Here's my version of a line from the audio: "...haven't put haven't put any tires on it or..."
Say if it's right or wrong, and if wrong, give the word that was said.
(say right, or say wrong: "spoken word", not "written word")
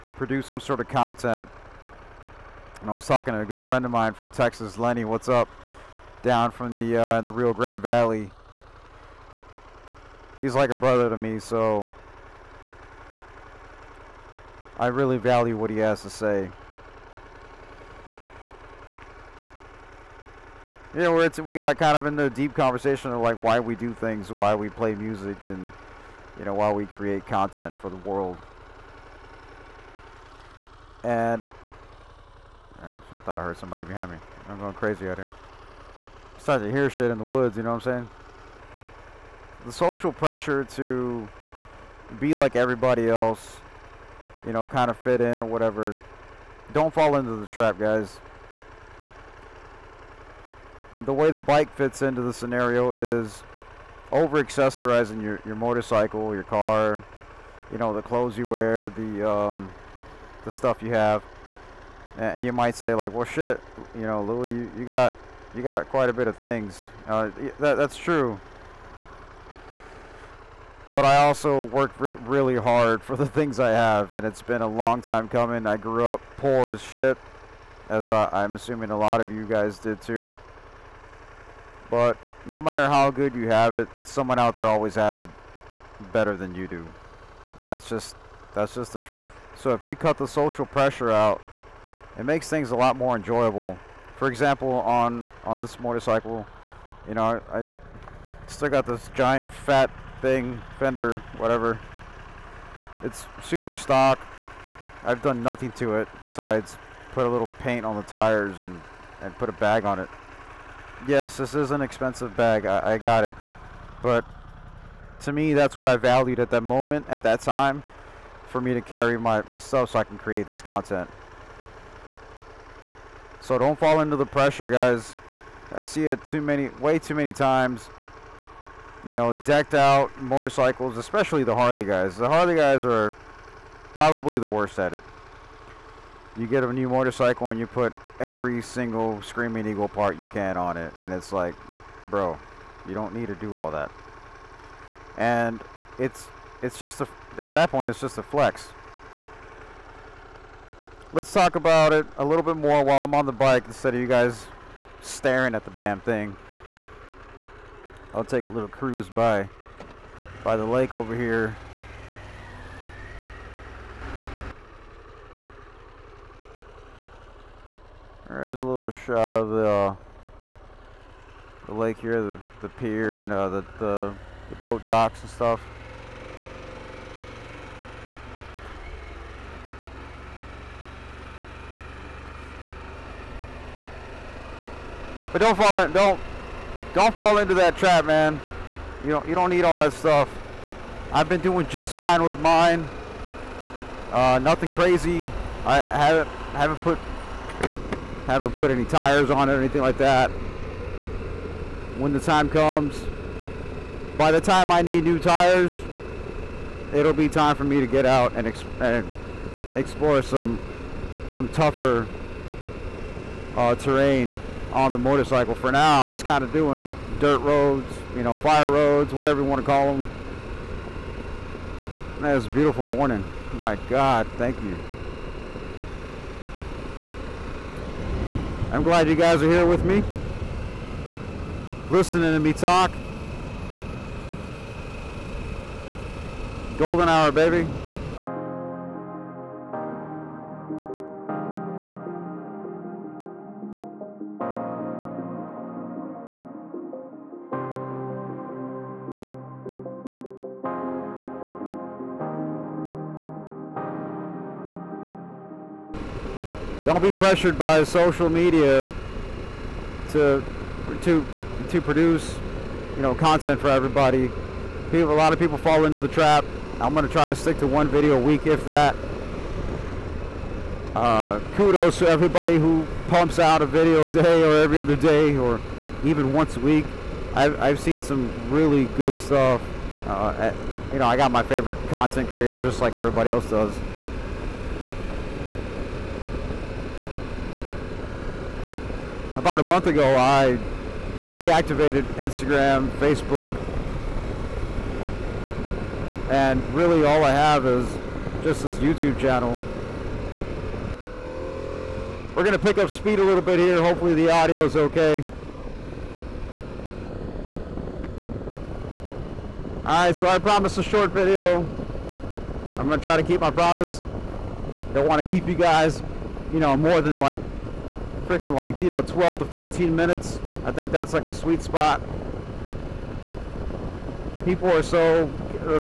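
right.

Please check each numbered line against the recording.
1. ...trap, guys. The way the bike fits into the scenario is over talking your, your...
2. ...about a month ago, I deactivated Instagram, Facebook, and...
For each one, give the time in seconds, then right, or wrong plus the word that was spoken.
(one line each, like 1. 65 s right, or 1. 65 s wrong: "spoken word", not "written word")
1. 47 s wrong: "accessorizing", not "talking"
2. 289 s right.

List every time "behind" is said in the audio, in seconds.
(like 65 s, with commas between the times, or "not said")
33 s.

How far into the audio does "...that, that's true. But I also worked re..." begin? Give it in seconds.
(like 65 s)
67 s.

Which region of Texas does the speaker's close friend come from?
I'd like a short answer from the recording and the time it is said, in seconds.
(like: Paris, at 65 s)
Rio Grande Valley, at 7 s.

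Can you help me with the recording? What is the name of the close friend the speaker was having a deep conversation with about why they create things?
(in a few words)
Lenny.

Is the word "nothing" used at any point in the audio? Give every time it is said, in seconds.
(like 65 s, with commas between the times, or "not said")
105 s, 194 s.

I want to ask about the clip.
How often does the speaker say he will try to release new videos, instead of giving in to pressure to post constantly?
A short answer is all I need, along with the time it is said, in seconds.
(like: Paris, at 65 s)
one video a week, at 267 s.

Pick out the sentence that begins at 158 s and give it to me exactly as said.
I'll take a little cruise by by the lake over here.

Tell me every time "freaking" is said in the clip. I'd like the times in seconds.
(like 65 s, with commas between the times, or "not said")
318 s.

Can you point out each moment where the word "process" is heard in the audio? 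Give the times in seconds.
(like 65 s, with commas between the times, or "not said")
not said.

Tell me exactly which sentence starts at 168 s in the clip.
There's a little shot of the uh, the lake here, the, the pier and uh, the, the the boat docks and stuff.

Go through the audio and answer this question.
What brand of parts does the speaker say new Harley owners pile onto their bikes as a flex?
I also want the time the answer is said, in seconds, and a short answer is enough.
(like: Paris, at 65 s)
Screaming Eagle, at 139 s.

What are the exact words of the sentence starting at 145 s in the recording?
And it's it's just a at that point, it's just a flex.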